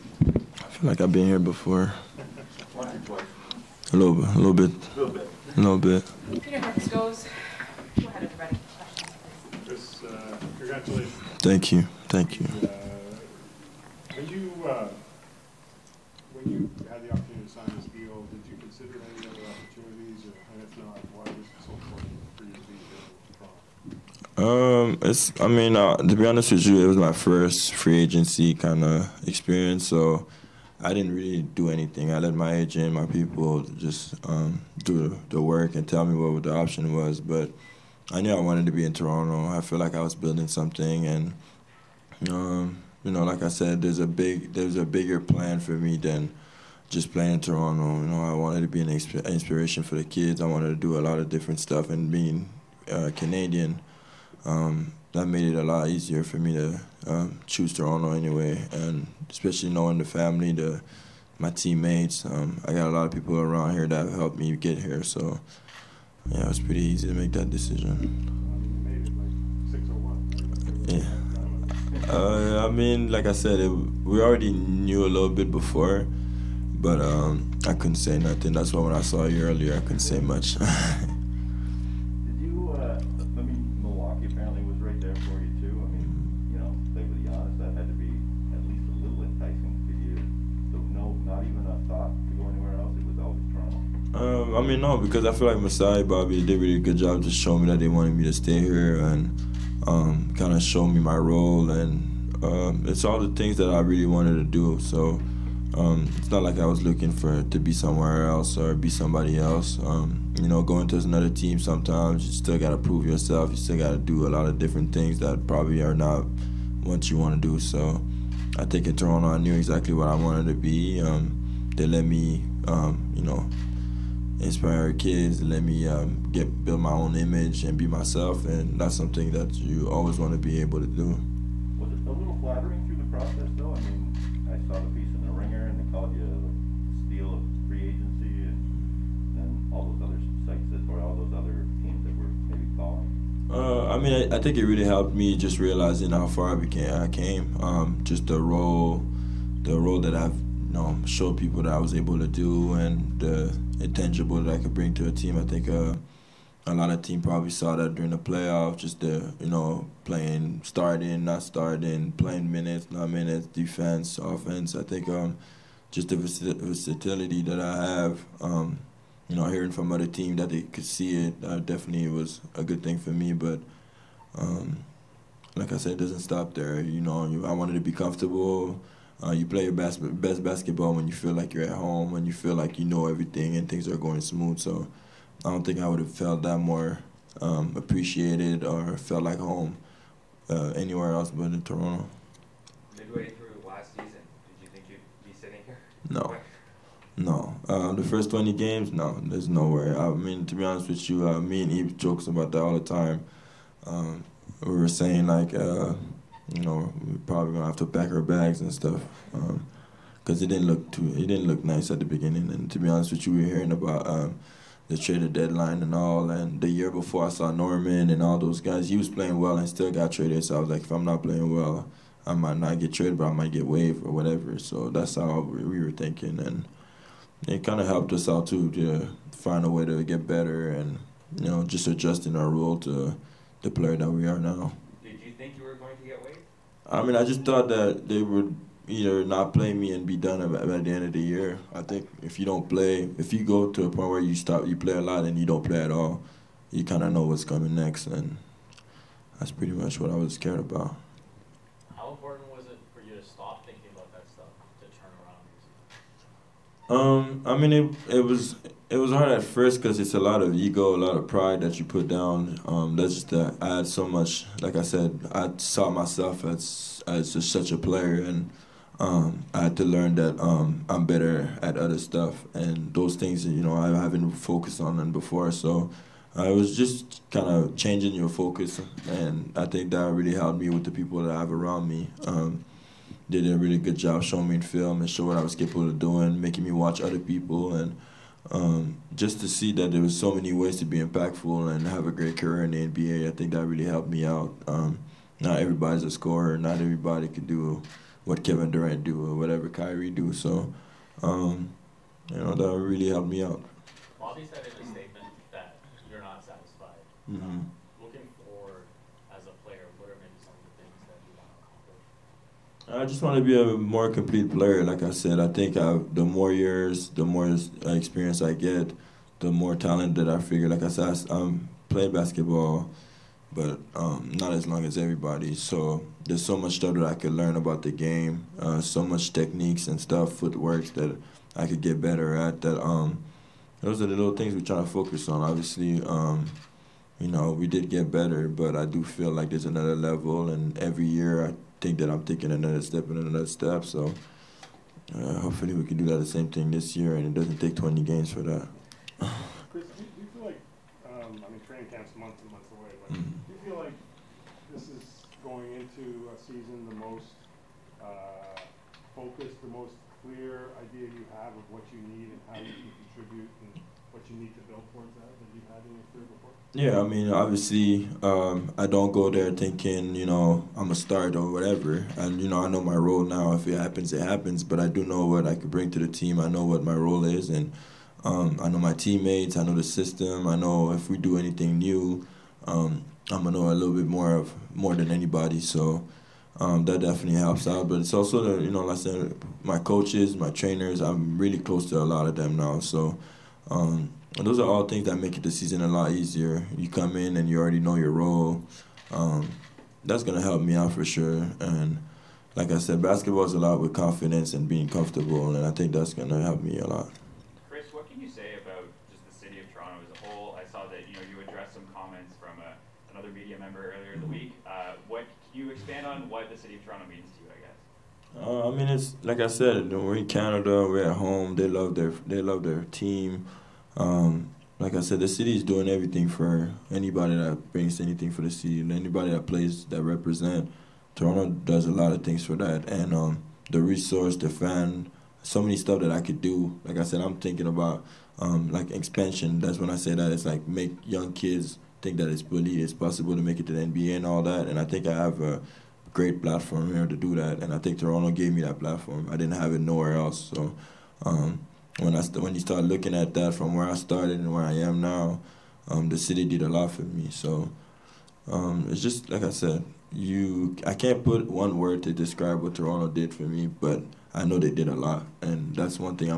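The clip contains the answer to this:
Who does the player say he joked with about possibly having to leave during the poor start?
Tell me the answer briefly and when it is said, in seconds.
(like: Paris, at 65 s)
Eve, at 201 s.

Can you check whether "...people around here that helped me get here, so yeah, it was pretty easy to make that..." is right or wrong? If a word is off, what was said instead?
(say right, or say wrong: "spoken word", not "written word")
right.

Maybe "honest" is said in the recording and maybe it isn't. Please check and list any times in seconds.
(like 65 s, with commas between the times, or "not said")
26 s, 87 s, 200 s, 212 s.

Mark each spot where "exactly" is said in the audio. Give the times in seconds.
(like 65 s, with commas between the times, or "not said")
119 s.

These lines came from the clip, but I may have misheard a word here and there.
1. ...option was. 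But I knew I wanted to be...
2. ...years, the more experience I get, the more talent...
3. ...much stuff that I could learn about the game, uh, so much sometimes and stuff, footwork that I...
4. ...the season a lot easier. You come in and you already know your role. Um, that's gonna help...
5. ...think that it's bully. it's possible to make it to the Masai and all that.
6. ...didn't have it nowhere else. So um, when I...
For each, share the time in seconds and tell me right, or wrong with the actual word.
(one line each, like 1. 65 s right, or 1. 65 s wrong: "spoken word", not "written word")
1. 36 s right
2. 316 s right
3. 326 s wrong: "techniques", not "sometimes"
4. 395 s right
5. 442 s wrong: "NBA", not "Masai"
6. 449 s right.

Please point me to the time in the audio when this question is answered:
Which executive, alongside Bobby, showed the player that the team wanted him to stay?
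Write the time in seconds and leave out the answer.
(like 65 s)
95 s.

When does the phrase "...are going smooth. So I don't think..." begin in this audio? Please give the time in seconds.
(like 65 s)
183 s.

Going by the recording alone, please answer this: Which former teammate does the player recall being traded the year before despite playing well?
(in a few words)
Norman.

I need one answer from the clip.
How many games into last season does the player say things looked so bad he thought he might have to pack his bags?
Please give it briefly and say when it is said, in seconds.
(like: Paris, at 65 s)
20, at 197 s.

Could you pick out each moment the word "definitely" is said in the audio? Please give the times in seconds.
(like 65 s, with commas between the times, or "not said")
171 s, 386 s.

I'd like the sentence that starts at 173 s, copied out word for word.
But um, like I said, it doesn't stop there.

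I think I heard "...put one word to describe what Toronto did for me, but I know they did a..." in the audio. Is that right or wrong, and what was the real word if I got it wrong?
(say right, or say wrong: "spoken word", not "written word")
right.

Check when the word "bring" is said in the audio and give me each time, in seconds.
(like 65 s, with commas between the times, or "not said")
154 s, 375 s, 427 s.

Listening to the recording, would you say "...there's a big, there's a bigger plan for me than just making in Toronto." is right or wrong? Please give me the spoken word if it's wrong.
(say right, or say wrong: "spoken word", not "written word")
wrong: "playing", not "making".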